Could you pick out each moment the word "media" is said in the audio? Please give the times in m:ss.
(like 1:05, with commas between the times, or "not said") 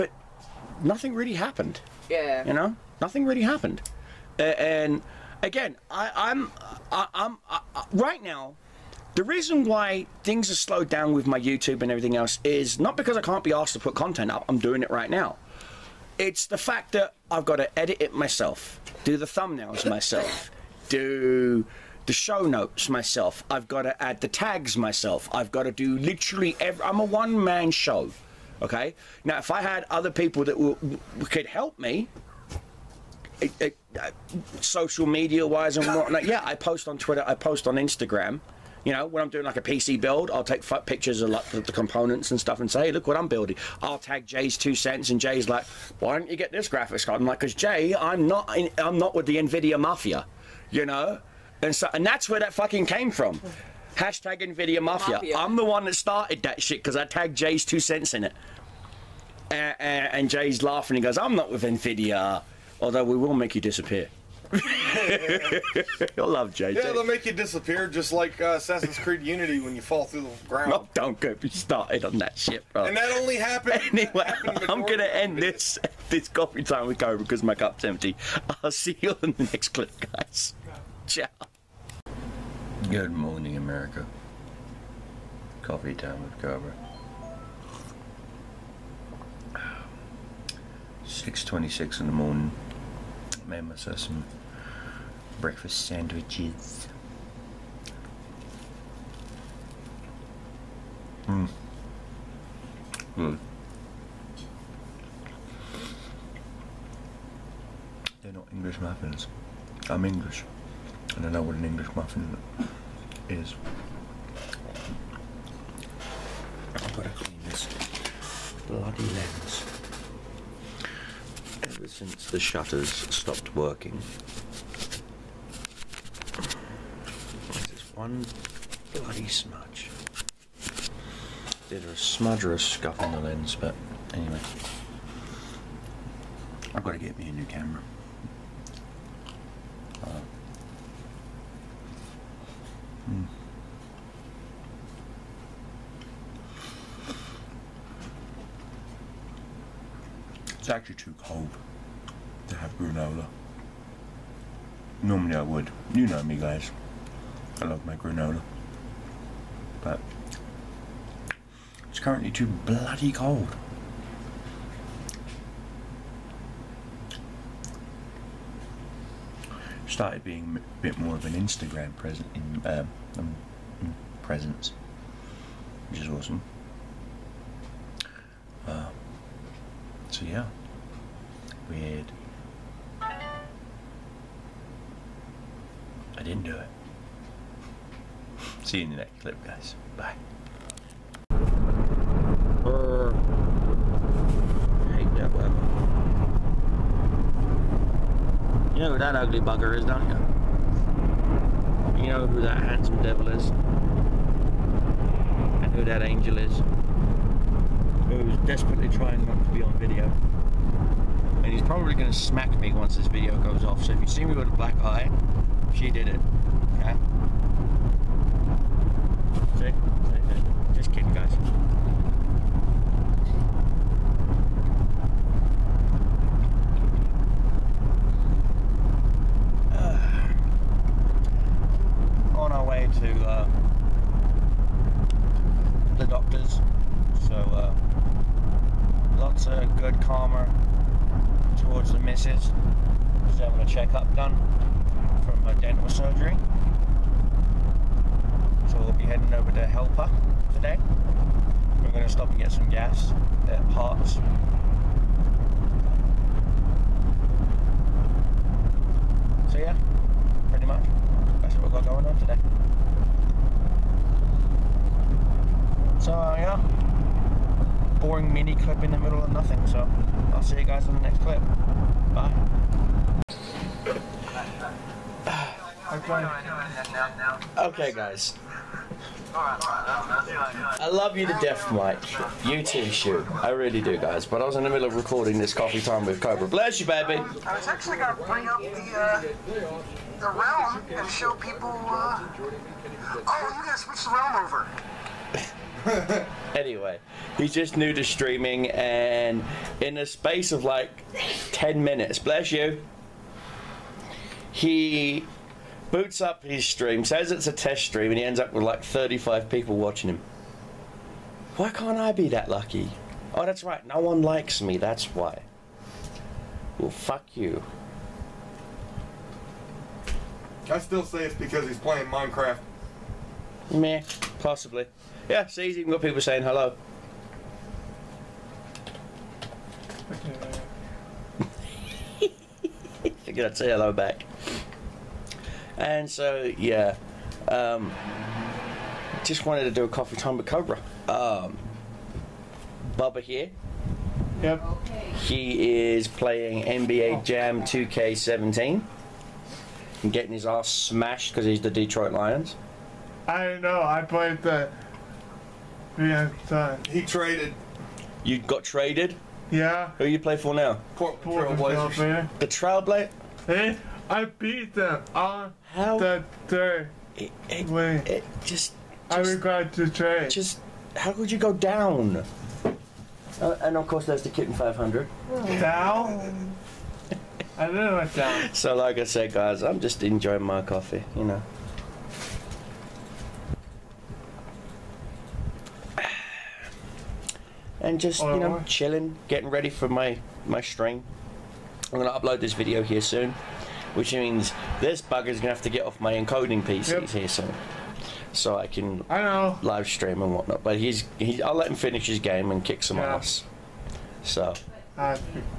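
0:35.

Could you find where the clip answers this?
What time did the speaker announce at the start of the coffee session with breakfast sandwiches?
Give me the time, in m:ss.
1:31.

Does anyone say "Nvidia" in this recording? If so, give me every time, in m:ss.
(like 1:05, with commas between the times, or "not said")
0:49, 0:54, 1:01.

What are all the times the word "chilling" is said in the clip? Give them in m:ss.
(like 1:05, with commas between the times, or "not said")
6:28.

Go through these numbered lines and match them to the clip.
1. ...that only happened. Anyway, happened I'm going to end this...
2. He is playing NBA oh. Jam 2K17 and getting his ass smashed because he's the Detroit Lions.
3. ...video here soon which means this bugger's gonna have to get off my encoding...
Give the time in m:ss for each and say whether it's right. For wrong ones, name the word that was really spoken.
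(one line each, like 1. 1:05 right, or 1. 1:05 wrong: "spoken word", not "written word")
1. 1:12 right
2. 5:45 right
3. 6:32 right.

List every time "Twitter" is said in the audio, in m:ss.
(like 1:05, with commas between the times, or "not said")
0:36.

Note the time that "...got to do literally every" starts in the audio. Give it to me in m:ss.
0:25.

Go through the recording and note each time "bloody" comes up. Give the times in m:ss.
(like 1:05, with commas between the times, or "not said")
1:58, 2:08, 2:42.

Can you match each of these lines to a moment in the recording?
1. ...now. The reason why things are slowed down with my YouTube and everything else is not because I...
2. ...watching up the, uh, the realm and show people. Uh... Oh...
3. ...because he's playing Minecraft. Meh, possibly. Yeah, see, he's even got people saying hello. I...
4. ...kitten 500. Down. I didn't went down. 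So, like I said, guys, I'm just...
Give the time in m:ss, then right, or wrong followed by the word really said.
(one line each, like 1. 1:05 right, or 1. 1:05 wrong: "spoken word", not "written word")
1. 0:08 right
2. 4:48 wrong: "bring", not "watching"
3. 5:21 right
4. 6:14 right.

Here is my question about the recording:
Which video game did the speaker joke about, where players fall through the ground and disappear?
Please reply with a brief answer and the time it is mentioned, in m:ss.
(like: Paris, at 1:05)
Assassin's Creed Unity, at 1:08.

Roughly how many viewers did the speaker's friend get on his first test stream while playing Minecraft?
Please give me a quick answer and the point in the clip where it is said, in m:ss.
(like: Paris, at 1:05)
35, at 5:08.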